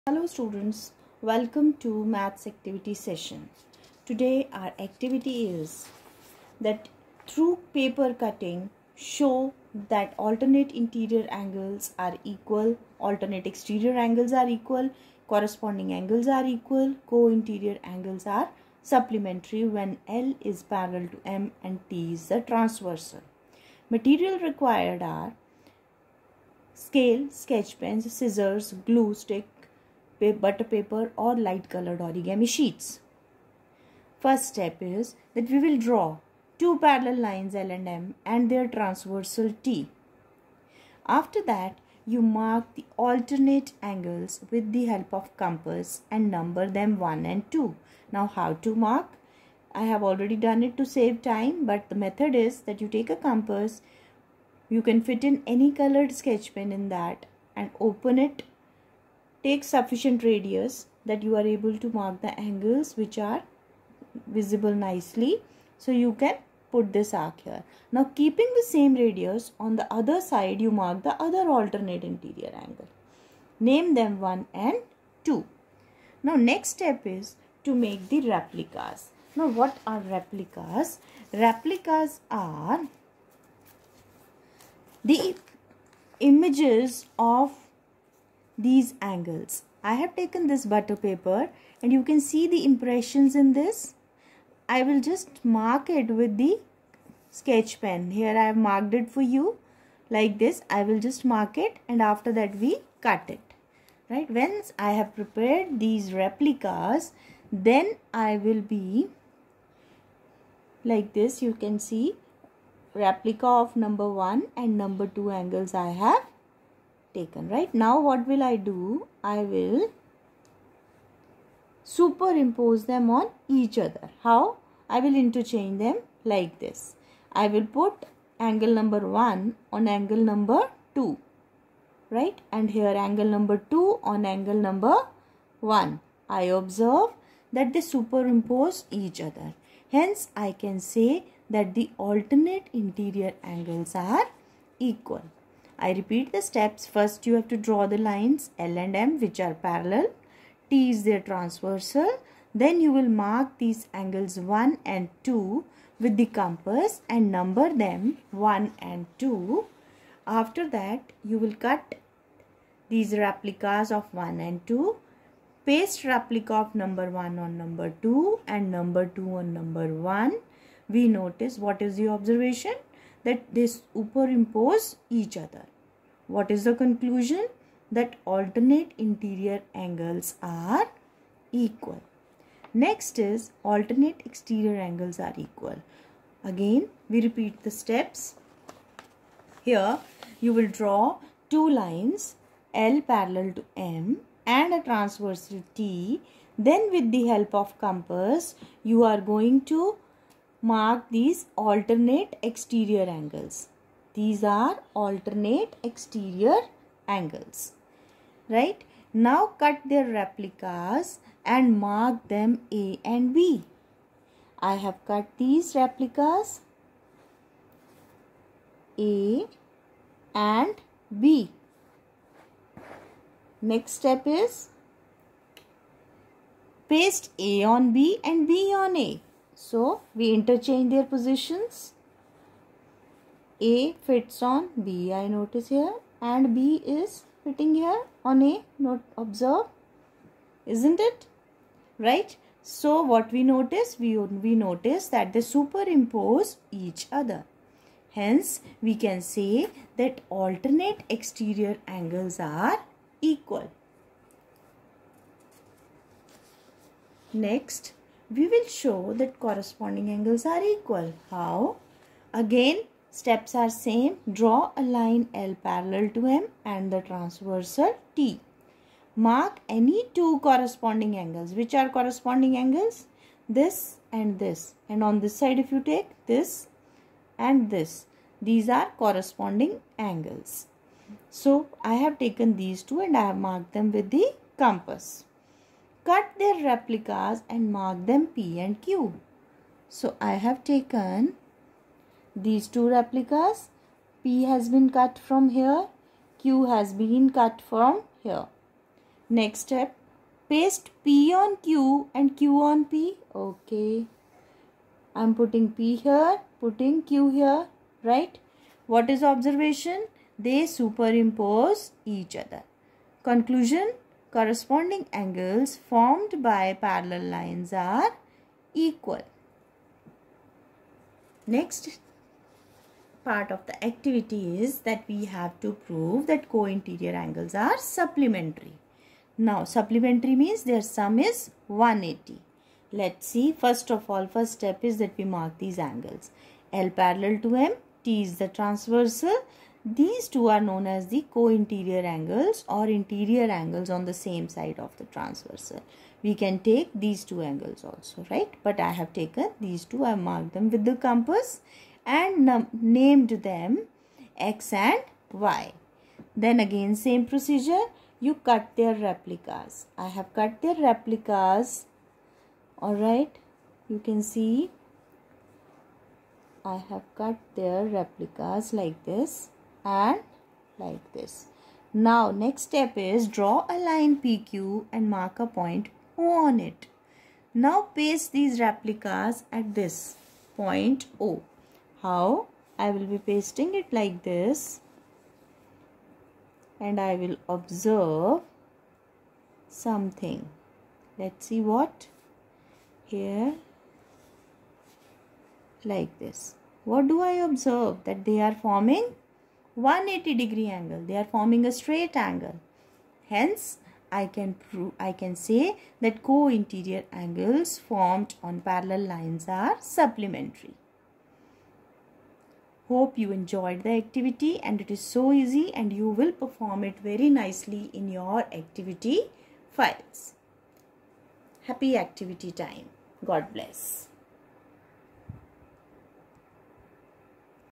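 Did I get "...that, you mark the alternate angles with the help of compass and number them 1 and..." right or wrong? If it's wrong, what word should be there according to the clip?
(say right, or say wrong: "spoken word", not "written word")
right.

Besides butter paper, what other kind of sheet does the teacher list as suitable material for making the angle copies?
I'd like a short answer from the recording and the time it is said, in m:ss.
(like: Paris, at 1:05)
light colored origami sheets, at 0:31.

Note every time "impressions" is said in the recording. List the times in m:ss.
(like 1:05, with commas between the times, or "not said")
1:32.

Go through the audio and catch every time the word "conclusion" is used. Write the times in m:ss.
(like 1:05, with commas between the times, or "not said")
2:56, 5:13.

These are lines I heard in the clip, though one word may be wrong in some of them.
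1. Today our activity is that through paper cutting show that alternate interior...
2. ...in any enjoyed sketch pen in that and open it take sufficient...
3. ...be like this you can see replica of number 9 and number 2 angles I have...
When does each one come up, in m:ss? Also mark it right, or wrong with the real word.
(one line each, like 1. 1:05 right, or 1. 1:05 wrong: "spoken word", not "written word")
1. 0:04 right
2. 0:55 wrong: "colored", not "enjoyed"
3. 1:48 wrong: "1", not "9".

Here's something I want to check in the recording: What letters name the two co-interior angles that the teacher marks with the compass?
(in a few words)
x and y.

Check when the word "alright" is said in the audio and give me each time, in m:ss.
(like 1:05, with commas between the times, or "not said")
6:02.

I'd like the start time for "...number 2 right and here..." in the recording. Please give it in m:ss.
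2:10.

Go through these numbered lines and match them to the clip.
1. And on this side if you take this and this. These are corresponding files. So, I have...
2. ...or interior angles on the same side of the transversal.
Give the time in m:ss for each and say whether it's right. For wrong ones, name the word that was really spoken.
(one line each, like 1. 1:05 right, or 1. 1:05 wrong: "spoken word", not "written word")
1. 4:34 wrong: "angles", not "files"
2. 5:42 right.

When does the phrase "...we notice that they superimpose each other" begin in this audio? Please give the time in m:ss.
4:04.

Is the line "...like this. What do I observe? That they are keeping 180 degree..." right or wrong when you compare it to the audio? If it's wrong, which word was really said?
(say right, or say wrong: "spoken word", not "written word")
wrong: "forming", not "keeping".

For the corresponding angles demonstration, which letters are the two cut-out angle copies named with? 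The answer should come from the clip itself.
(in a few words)
P and Q.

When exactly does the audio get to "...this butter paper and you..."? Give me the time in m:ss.
1:30.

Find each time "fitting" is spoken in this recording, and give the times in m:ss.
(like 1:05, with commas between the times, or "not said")
3:57.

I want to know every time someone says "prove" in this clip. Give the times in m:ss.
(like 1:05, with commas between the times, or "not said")
5:25, 6:44.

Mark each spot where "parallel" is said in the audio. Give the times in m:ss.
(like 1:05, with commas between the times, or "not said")
0:20, 0:36, 2:29, 3:13, 4:25, 5:16, 5:36, 6:48.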